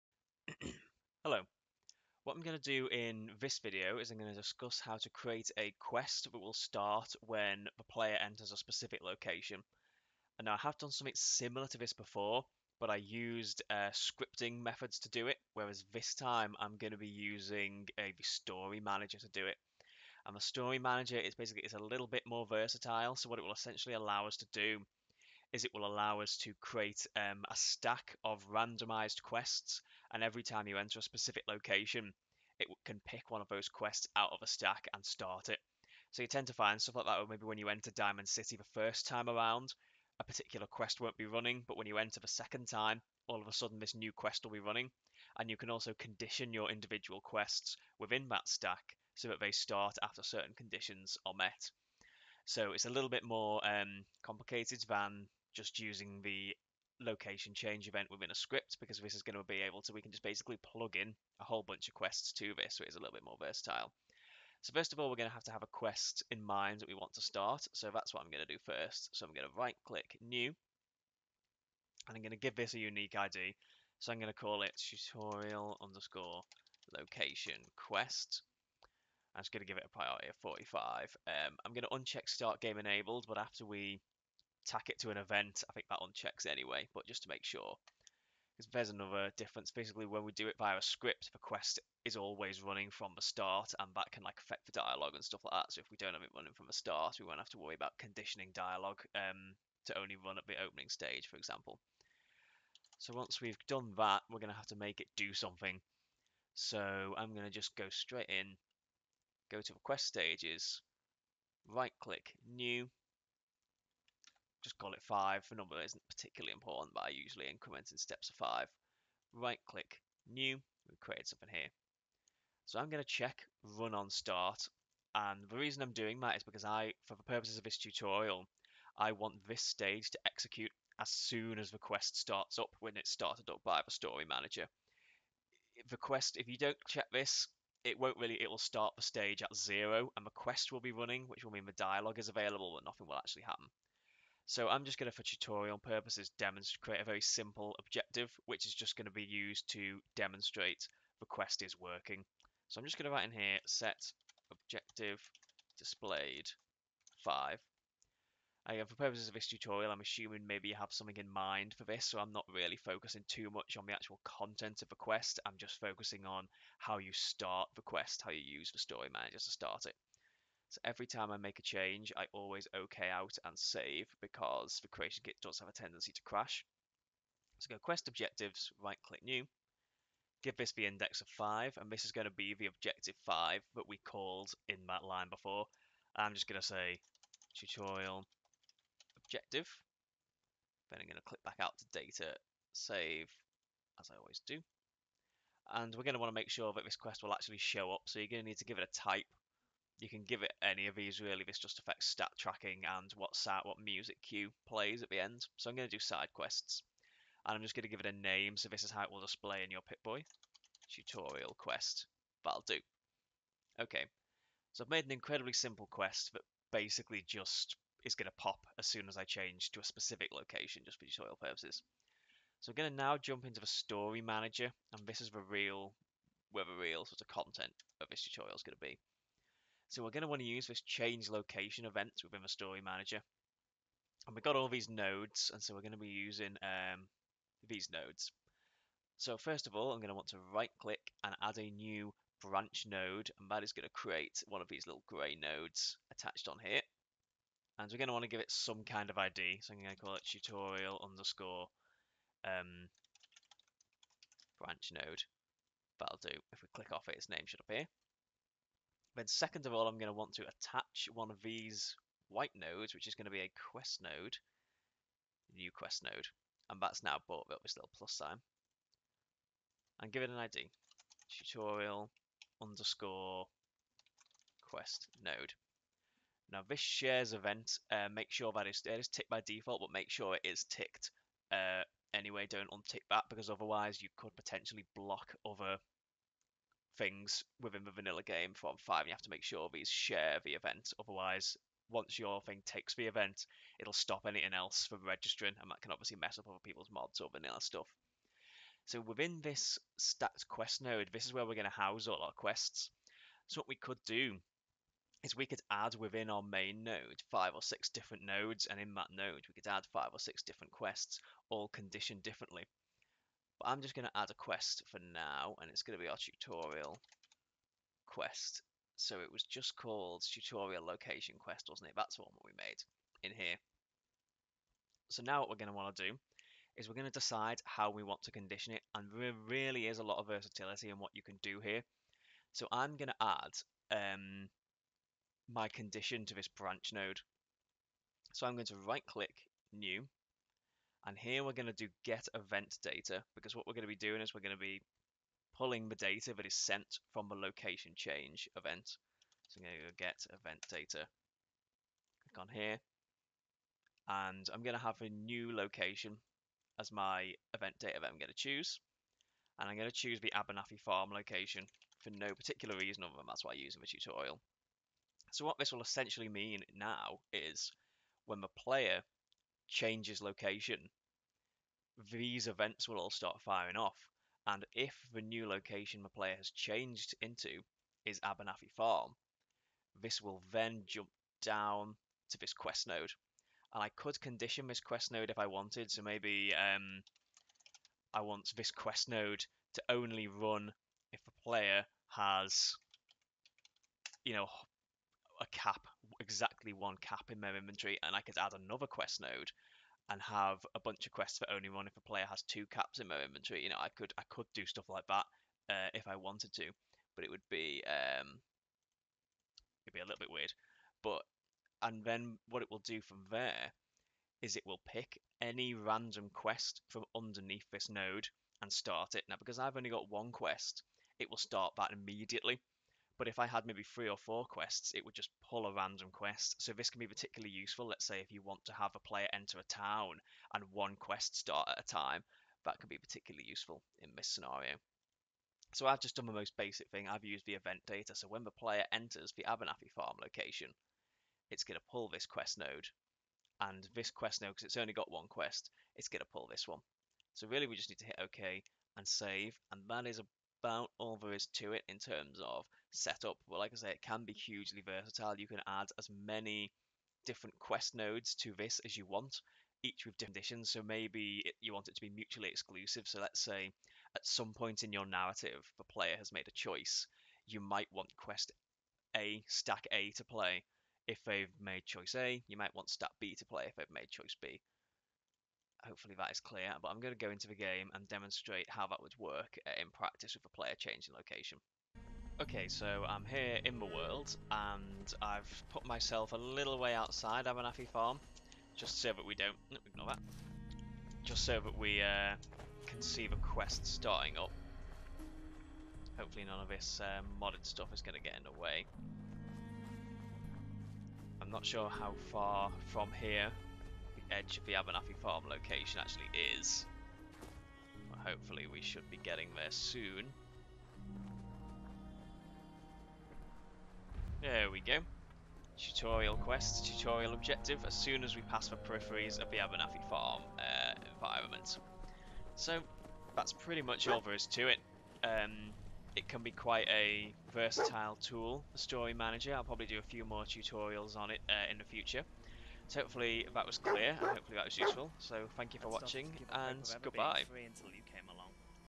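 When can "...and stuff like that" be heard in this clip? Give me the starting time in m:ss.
1:35.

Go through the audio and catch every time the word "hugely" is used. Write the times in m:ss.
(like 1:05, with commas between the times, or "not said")
7:34.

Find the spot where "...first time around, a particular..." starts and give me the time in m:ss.
0:38.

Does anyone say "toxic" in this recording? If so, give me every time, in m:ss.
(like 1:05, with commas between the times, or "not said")
not said.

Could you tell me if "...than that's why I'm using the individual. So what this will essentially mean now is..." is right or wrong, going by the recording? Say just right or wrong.
wrong.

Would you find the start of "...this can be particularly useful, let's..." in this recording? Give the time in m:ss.
7:06.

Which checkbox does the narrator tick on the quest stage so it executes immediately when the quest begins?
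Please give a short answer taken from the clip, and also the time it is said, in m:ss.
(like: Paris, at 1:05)
Run on start, at 2:03.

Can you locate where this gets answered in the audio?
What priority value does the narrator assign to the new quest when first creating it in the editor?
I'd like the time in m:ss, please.
1:20.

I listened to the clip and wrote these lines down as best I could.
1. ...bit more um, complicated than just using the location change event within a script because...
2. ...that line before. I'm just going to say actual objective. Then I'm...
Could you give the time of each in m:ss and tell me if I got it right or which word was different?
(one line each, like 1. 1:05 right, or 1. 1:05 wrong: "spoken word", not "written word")
1. 0:53 right
2. 3:04 wrong: "tutorial", not "actual".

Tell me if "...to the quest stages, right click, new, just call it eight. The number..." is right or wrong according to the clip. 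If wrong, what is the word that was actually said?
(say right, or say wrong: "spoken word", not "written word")
wrong: "five", not "eight".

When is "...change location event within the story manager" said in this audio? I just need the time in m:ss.
3:50.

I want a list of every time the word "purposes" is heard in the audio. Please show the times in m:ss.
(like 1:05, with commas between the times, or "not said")
2:07, 2:25, 2:38, 3:41.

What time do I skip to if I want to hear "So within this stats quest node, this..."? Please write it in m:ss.
4:58.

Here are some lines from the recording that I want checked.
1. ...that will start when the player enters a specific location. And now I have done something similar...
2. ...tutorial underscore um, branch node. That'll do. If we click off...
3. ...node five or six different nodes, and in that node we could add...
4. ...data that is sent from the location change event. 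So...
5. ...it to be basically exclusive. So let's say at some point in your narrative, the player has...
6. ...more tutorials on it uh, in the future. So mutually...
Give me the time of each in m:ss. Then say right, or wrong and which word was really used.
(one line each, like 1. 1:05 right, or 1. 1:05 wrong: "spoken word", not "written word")
1. 0:06 right
2. 4:10 right
3. 5:06 right
4. 5:45 right
5. 7:41 wrong: "mutually", not "basically"
6. 8:50 wrong: "hopefully", not "mutually".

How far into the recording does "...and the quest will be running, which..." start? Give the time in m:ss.
2:20.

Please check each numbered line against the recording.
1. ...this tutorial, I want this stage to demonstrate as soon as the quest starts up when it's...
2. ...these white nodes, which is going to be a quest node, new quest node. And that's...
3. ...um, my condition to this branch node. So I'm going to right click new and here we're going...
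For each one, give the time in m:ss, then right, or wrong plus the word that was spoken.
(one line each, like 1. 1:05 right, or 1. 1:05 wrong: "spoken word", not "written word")
1. 2:07 wrong: "execute", not "demonstrate"
2. 4:21 right
3. 5:34 right.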